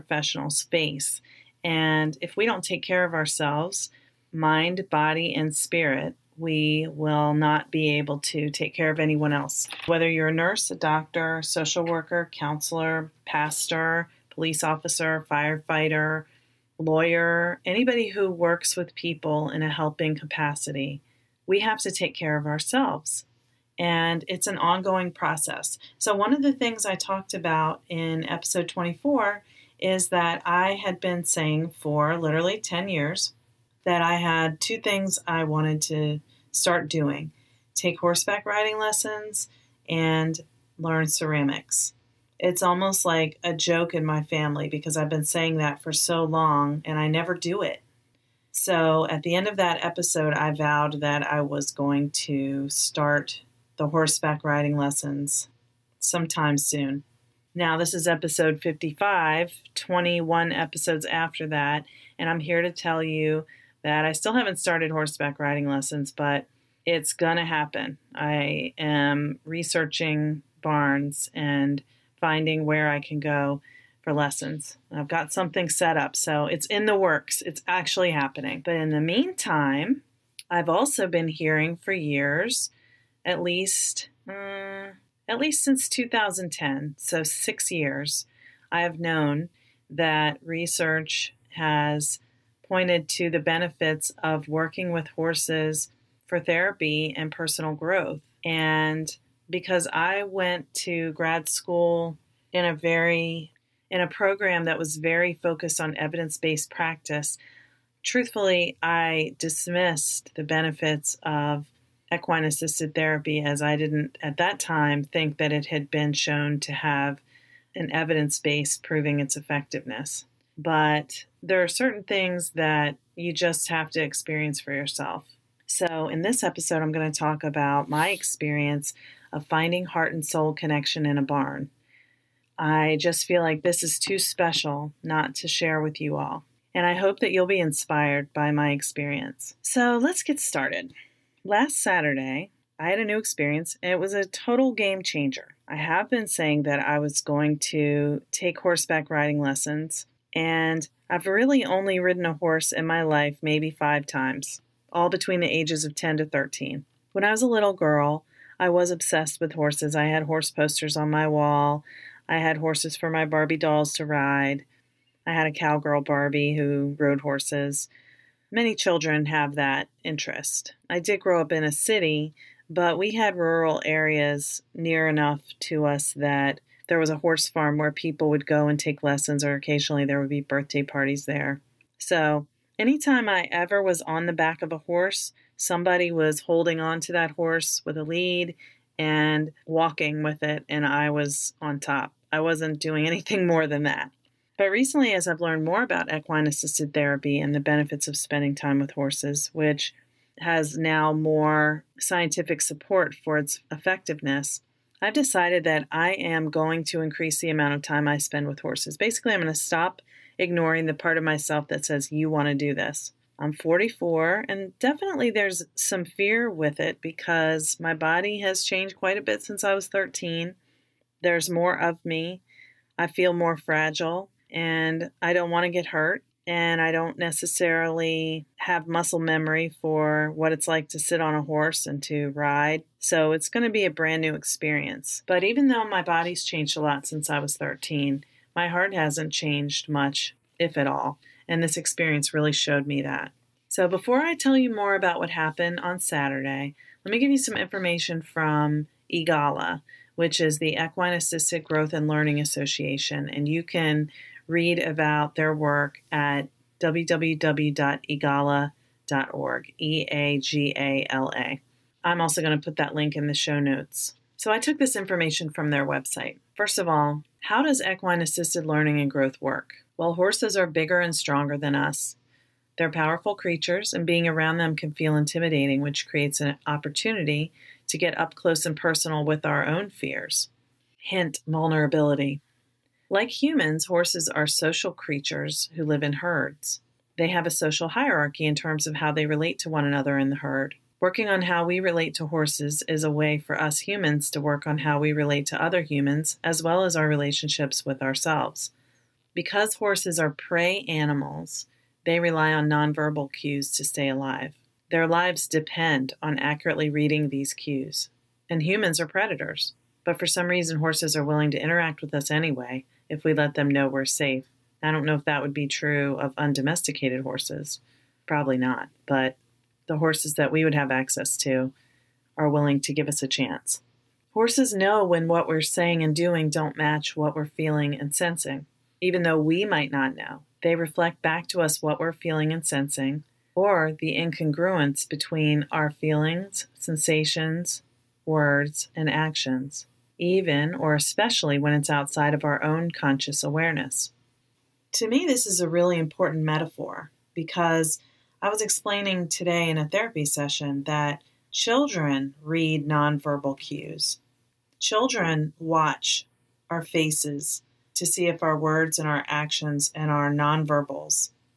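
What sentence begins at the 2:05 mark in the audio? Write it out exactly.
So, in this episode, I'm going to talk about my experience of finding heart and soul connection in a barn.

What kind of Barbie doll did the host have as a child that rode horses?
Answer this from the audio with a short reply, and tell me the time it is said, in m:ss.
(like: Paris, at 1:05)
cowgirl Barbie, at 2:45.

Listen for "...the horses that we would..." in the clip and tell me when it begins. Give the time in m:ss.
5:19.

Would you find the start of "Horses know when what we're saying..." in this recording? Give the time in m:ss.
5:24.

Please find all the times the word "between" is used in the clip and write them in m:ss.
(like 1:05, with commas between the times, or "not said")
2:35, 5:35.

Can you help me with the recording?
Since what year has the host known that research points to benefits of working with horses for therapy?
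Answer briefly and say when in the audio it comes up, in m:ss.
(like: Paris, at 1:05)
2010, at 1:25.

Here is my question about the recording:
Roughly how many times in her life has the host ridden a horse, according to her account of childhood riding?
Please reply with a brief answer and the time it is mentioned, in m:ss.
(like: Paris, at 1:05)
5, at 2:33.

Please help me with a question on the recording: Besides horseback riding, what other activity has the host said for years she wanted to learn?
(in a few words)
ceramics.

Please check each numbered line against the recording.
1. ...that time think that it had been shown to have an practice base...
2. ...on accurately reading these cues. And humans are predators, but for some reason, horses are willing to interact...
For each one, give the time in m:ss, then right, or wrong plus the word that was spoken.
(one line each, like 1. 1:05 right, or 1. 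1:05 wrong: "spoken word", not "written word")
1. 1:54 wrong: "evidence", not "practice"
2. 5:06 right.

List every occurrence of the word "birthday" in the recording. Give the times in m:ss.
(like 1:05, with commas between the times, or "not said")
3:00.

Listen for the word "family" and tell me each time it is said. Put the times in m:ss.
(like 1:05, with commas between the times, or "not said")
0:44.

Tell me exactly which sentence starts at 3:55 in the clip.
But even though my body's changed a lot since I was 13, my heart hasn't changed much, if at all.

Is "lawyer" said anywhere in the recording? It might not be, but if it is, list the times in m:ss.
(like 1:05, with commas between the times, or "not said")
0:16.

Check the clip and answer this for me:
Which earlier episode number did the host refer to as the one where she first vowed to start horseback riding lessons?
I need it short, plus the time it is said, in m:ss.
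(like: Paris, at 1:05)
24, at 0:28.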